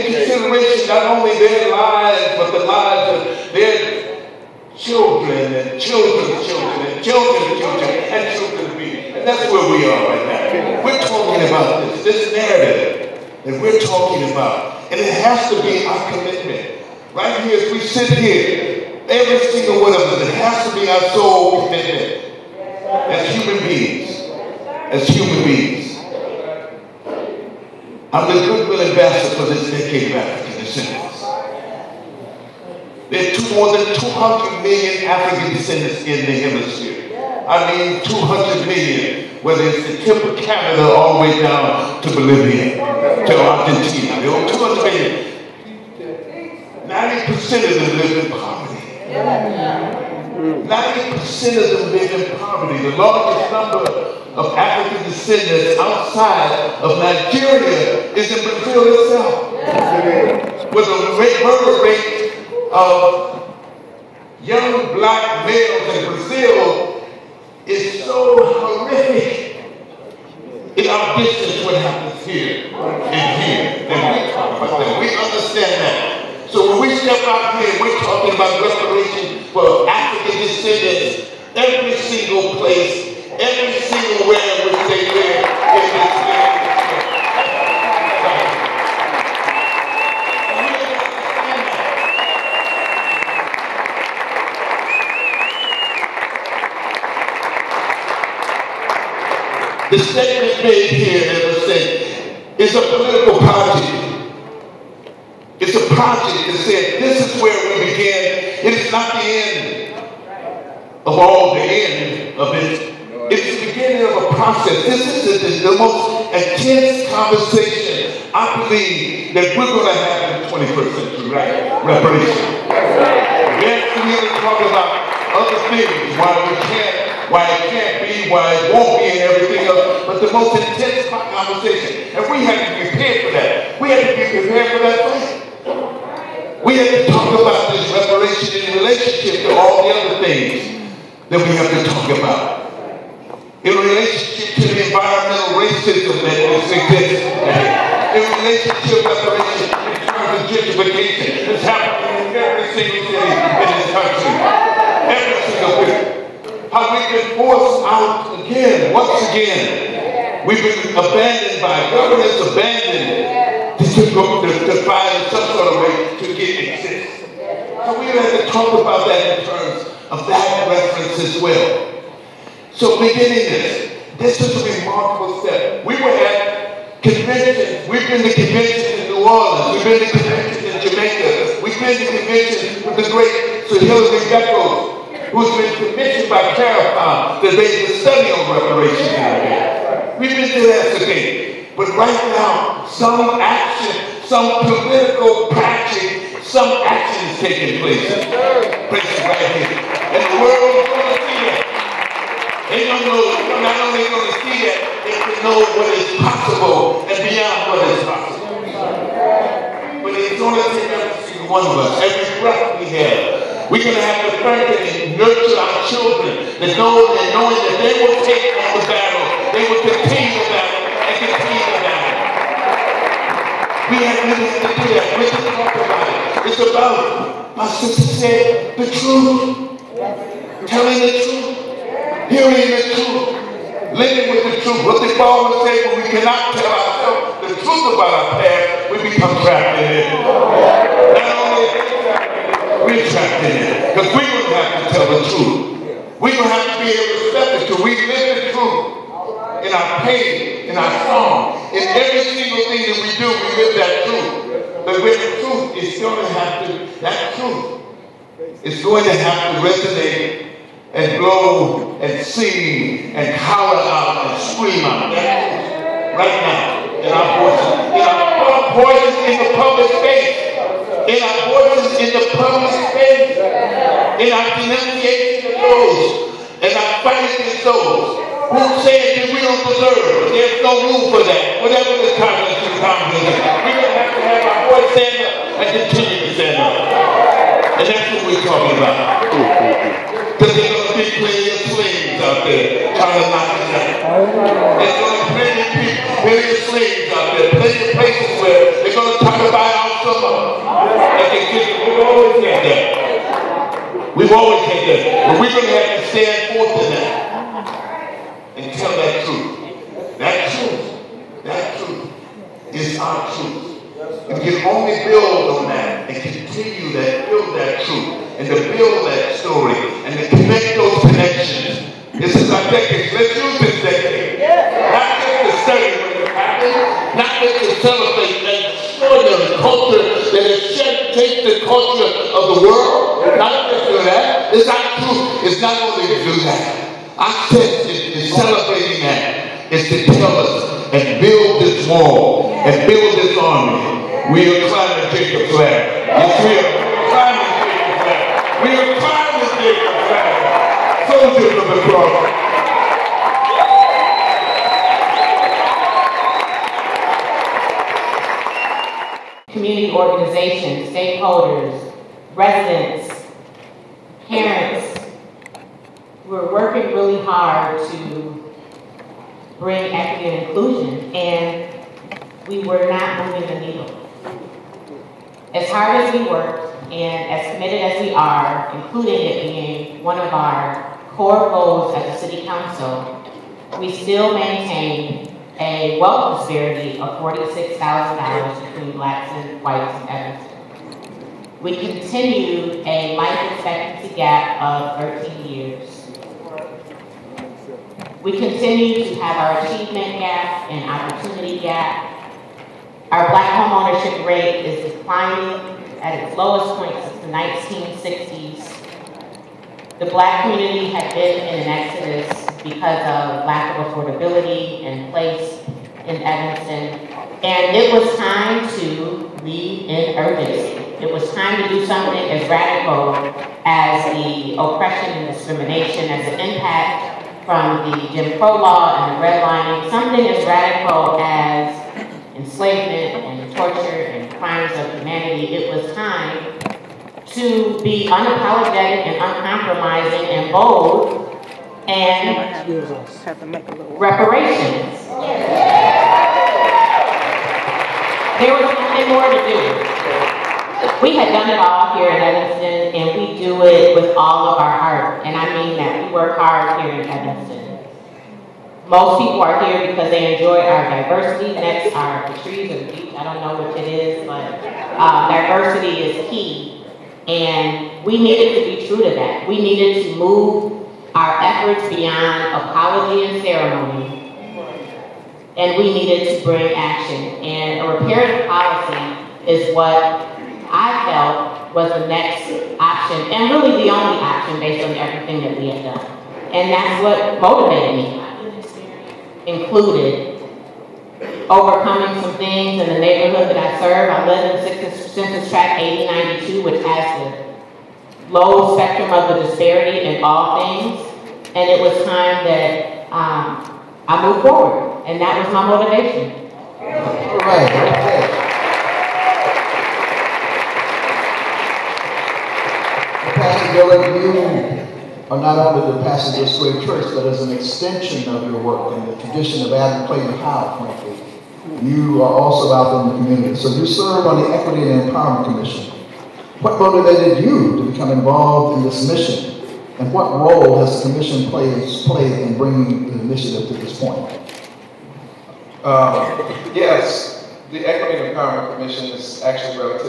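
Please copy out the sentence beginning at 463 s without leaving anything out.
I don't know which it is, but uh, diversity is key.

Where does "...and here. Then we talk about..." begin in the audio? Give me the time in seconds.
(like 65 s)
72 s.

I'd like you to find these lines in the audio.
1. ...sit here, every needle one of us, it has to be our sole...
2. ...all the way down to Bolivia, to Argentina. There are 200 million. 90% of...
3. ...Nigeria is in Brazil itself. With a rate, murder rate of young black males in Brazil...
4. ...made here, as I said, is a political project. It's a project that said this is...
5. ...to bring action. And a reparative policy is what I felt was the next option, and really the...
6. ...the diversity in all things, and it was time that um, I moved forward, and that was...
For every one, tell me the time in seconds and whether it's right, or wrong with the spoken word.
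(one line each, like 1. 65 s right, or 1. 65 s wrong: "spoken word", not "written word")
1. 17 s wrong: "single", not "needle"
2. 40 s right
3. 56 s right
4. 100 s right
5. 476 s right
6. 499 s wrong: "disparity", not "diversity".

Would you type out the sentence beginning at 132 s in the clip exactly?
And we have to be prepared for that.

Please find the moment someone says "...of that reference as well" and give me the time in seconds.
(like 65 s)
170 s.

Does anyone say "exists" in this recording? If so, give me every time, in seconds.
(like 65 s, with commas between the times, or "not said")
146 s, 166 s.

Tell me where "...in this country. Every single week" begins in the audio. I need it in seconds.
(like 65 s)
153 s.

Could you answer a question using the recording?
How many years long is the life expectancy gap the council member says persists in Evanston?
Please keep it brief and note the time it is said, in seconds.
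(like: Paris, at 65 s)
13 years, at 395 s.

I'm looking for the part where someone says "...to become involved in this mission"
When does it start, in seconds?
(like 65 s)
527 s.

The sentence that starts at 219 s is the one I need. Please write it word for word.
They would continue about it and continue about it.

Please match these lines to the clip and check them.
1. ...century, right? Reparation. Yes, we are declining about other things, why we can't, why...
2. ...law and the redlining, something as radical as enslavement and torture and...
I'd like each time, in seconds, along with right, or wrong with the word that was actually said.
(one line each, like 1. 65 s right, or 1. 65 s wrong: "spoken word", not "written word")
1. 120 s wrong: "talking", not "declining"
2. 428 s right.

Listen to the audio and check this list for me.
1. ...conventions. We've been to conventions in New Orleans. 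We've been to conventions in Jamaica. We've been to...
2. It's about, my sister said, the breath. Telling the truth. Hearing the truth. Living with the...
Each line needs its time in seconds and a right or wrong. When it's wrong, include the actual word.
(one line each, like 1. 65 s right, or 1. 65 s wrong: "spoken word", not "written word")
1. 177 s right
2. 226 s wrong: "truth", not "breath".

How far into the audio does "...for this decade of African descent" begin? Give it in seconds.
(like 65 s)
29 s.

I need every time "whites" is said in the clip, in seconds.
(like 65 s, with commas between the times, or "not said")
389 s.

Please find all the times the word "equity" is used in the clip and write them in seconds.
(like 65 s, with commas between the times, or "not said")
369 s, 524 s, 537 s.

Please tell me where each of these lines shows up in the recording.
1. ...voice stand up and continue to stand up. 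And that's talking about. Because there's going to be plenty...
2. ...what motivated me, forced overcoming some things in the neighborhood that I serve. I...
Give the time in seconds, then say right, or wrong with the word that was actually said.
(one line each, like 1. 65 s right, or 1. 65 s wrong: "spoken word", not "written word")
1. 284 s right
2. 487 s wrong: "included", not "forced".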